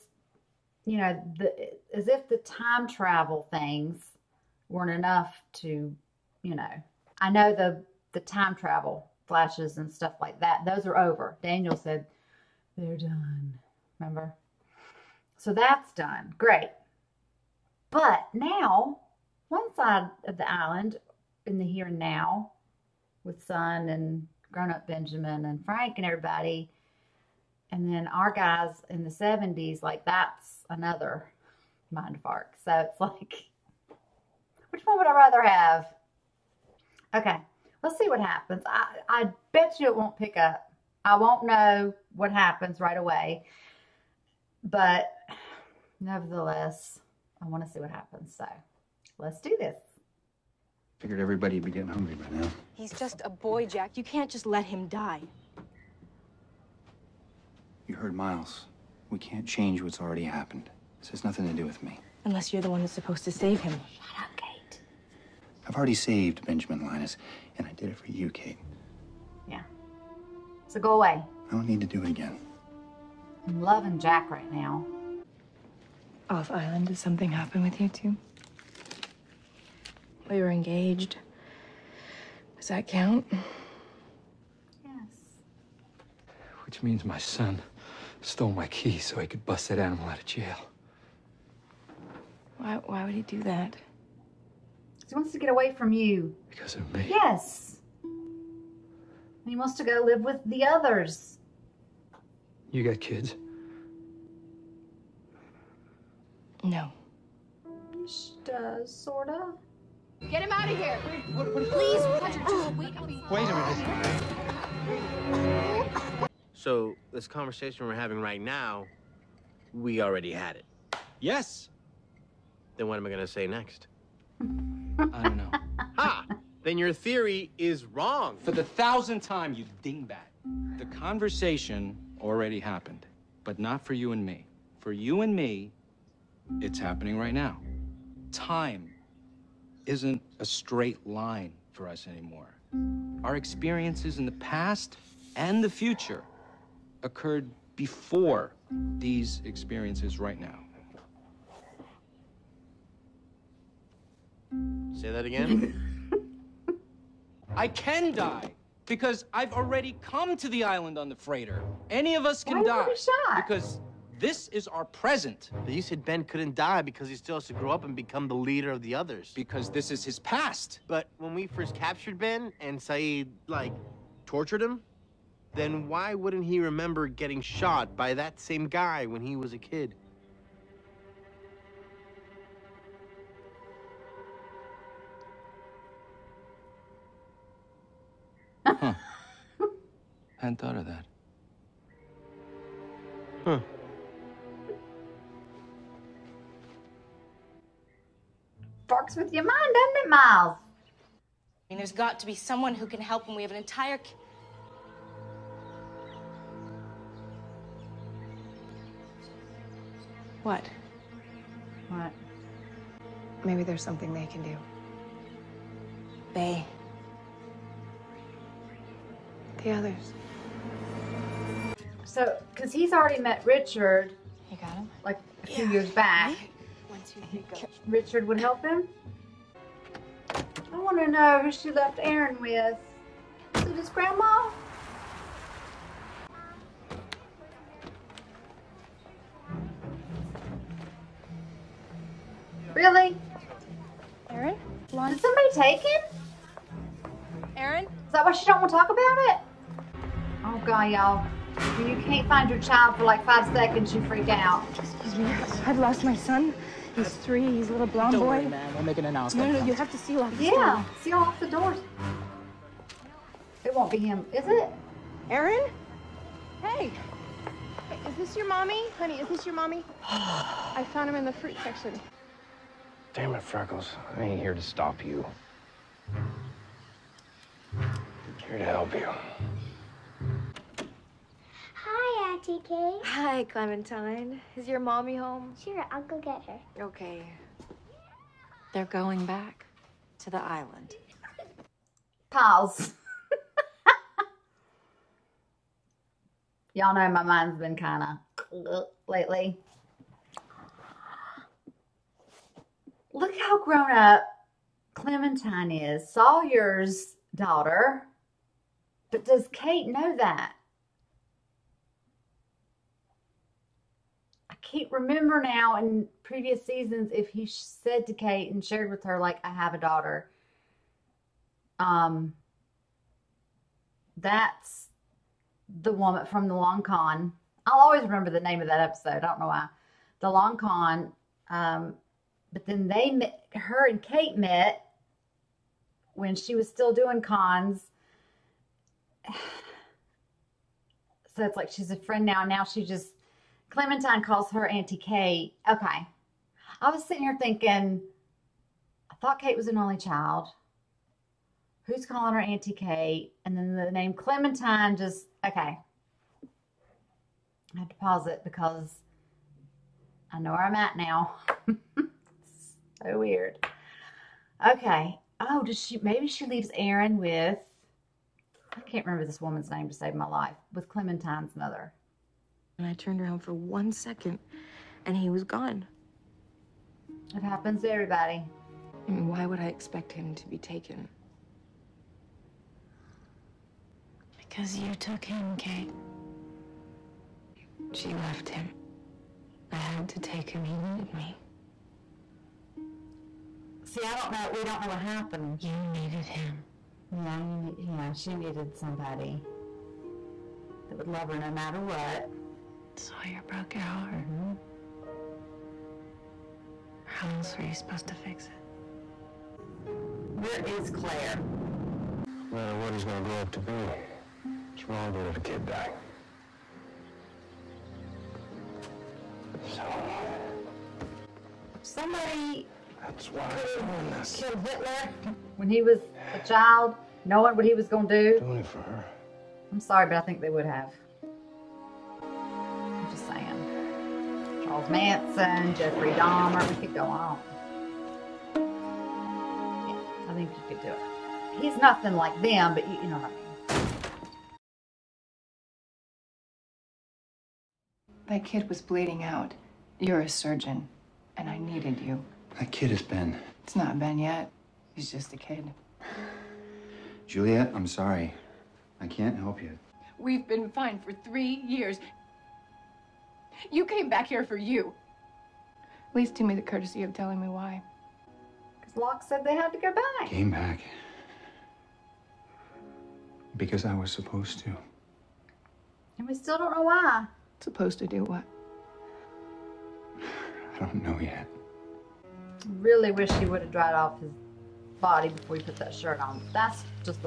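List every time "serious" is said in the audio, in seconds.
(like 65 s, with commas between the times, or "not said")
not said.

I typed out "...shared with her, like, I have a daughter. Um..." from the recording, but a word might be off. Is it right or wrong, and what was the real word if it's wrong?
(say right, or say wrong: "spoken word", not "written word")
right.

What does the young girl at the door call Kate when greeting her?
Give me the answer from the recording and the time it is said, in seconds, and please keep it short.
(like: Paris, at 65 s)
Auntie Kay, at 282 s.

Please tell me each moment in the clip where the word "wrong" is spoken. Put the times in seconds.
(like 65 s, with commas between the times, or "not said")
127 s, 414 s.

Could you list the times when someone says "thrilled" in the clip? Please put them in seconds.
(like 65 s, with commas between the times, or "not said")
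not said.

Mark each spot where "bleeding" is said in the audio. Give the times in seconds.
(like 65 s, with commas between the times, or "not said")
448 s.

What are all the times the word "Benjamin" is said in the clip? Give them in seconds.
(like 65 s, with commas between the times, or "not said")
24 s, 66 s.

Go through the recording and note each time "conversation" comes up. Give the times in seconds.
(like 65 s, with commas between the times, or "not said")
117 s, 130 s.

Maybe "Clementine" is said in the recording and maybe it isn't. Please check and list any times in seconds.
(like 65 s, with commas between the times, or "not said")
283 s, 304 s, 343 s, 354 s, 370 s.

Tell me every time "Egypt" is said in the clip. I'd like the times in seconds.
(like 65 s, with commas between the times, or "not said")
not said.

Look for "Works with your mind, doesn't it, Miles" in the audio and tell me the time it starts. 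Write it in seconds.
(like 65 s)
198 s.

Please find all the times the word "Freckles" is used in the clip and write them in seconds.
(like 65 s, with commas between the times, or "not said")
273 s.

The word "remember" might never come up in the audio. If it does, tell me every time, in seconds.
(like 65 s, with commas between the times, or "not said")
13 s, 176 s, 314 s, 328 s, 369 s.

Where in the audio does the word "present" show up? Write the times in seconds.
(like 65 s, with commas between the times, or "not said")
164 s.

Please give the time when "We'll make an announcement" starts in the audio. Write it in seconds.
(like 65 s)
258 s.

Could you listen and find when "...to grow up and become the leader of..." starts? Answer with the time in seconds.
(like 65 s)
167 s.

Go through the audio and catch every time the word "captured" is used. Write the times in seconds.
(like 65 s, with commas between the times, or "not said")
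171 s.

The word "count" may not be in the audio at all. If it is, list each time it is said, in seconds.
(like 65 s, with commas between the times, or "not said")
82 s.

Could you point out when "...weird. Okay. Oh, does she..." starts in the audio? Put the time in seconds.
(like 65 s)
363 s.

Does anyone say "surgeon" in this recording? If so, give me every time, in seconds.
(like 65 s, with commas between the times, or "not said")
450 s.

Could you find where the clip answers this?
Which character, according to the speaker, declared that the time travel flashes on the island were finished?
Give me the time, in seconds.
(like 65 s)
11 s.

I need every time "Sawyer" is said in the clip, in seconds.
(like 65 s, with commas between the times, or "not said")
306 s, 402 s.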